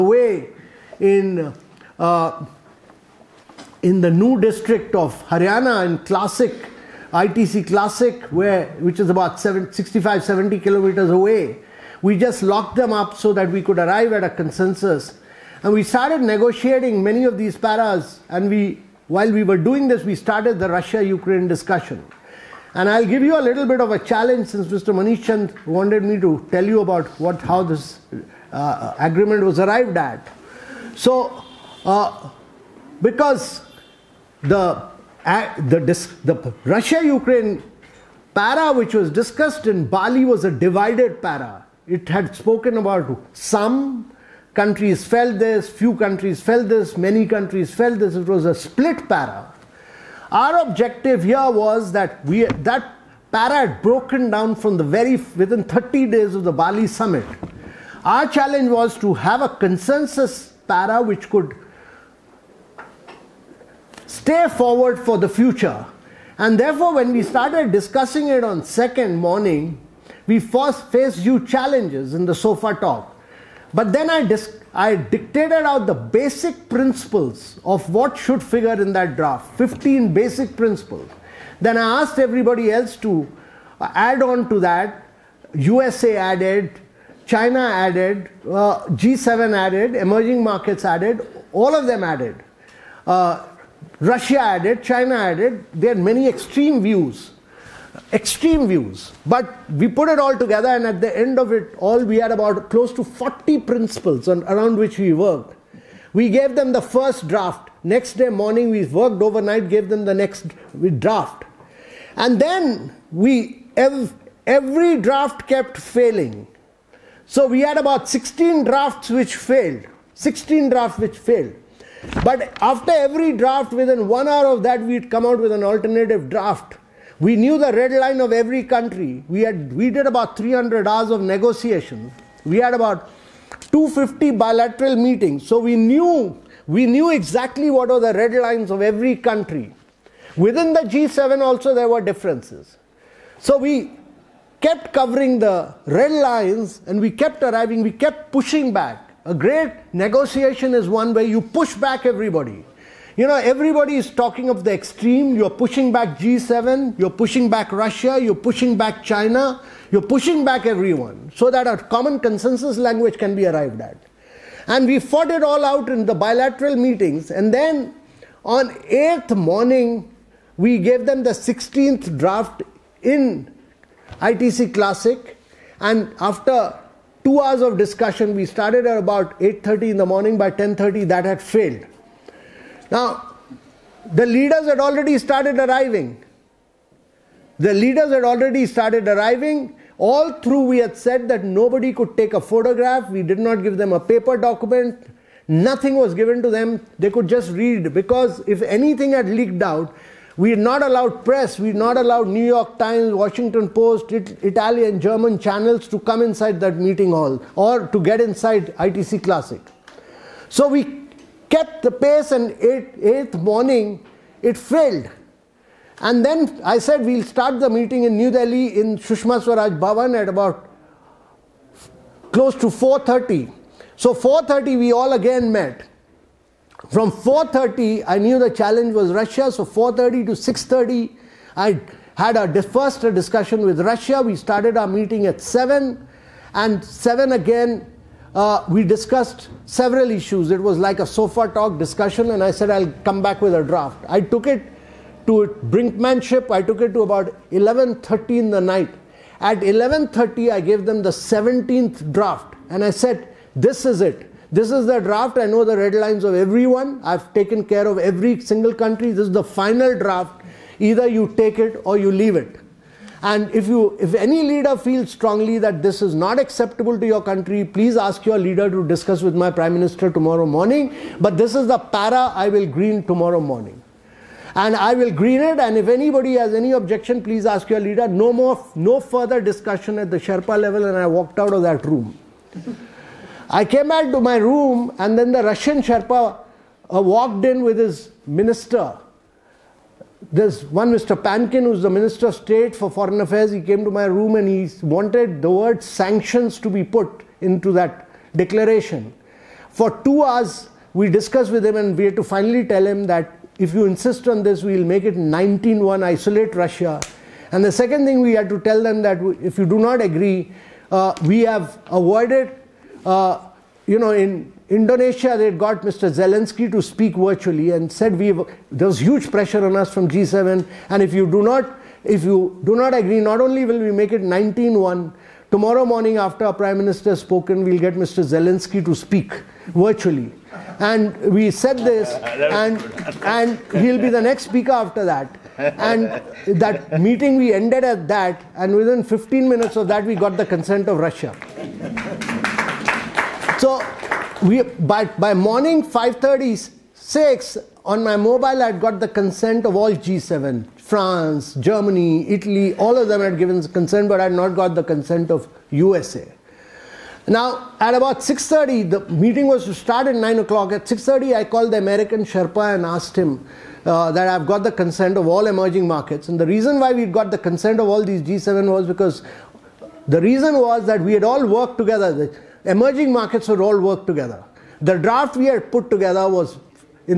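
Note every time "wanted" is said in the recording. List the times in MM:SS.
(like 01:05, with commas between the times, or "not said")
00:25, 04:54.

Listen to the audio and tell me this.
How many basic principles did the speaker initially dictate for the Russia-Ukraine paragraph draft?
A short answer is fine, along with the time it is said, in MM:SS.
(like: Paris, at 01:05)
15, at 01:19.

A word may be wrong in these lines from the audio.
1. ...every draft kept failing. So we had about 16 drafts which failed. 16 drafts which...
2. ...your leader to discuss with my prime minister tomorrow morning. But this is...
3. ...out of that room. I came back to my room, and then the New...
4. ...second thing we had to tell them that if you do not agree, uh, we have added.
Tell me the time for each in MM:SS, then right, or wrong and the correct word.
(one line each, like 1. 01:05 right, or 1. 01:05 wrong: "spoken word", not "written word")
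1. 01:54 right
2. 04:28 right
3. 04:41 wrong: "Russian", not "New"
4. 05:07 wrong: "avoided", not "added".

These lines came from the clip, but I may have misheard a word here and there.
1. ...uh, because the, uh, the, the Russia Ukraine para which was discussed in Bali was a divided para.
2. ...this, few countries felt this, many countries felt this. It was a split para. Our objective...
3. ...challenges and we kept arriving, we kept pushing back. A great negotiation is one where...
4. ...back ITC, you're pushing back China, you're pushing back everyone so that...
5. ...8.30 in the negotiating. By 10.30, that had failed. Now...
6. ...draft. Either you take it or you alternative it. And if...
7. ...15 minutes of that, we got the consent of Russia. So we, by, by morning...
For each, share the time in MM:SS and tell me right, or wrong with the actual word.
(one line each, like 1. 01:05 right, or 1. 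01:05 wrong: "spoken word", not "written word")
1. 00:31 right
2. 00:45 right
3. 02:26 wrong: "lines", not "challenges"
4. 02:37 wrong: "Russia", not "ITC"
5. 02:59 wrong: "morning", not "negotiating"
6. 04:19 wrong: "leave", not "alternative"
7. 05:39 right.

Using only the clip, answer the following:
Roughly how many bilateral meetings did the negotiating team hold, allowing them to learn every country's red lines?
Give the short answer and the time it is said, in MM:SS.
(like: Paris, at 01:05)
250, at 02:13.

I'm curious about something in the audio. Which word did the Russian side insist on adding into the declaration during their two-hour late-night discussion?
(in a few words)
Sanctions.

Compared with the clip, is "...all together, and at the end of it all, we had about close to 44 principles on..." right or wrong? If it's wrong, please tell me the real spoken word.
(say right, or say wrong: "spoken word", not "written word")
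wrong: "40", not "44".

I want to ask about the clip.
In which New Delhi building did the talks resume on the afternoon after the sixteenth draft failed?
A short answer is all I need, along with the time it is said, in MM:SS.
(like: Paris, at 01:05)
Sushma Swaraj Bhavan, at 03:38.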